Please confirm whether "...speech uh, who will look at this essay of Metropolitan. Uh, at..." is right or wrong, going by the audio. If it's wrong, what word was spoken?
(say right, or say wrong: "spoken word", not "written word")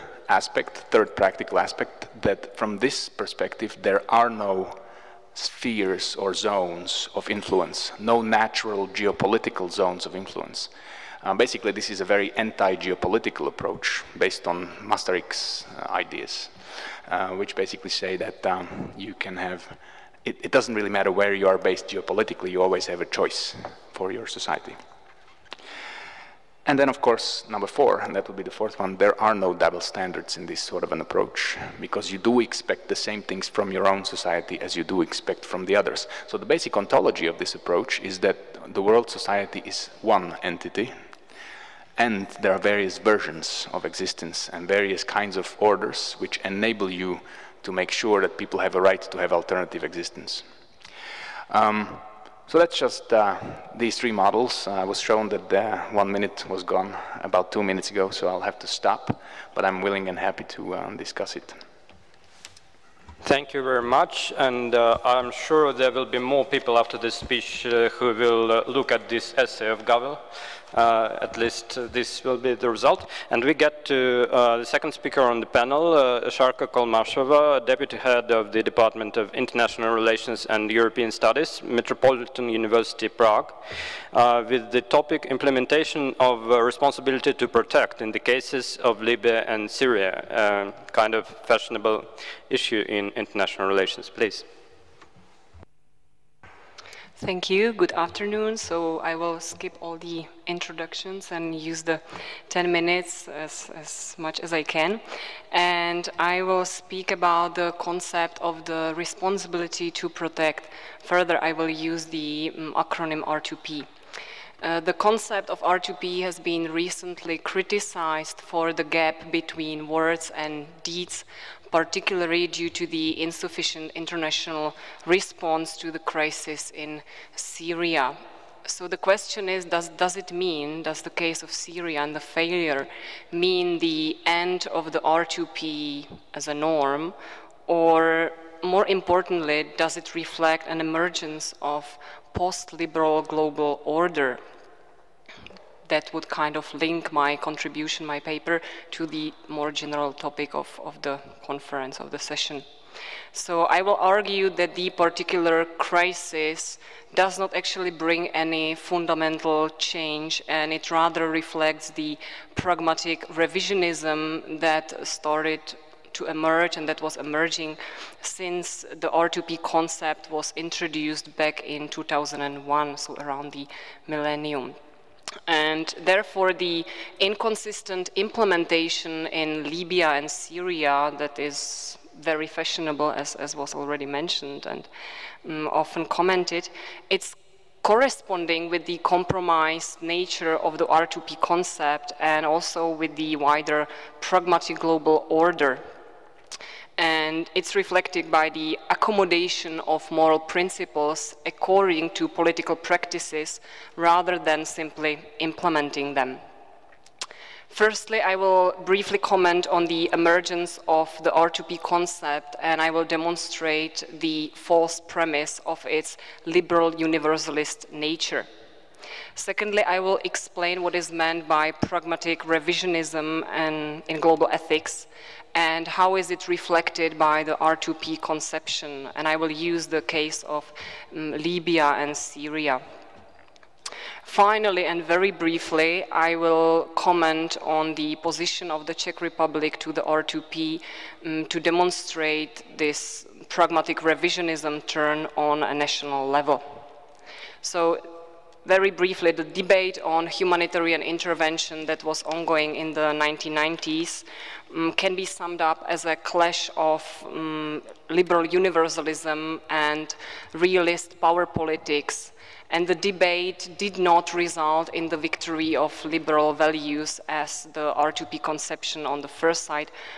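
wrong: "Havel", not "Metropolitan".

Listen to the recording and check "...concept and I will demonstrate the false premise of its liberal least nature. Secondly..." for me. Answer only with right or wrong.
wrong.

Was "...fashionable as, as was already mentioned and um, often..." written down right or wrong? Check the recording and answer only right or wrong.
right.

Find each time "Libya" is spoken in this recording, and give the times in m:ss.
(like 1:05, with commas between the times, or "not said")
1:28, 2:59, 3:51.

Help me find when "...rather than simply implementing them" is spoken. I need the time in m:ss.
3:23.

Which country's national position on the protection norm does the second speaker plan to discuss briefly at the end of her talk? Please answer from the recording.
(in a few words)
Czech Republic.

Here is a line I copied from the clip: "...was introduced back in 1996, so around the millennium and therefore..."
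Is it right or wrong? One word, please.
wrong.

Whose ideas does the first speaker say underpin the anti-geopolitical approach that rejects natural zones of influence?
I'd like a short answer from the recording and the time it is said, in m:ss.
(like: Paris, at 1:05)
Masaryk, at 0:14.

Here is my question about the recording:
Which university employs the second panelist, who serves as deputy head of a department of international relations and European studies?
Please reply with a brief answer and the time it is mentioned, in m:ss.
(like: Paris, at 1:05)
Metropolitan University Prague, at 1:21.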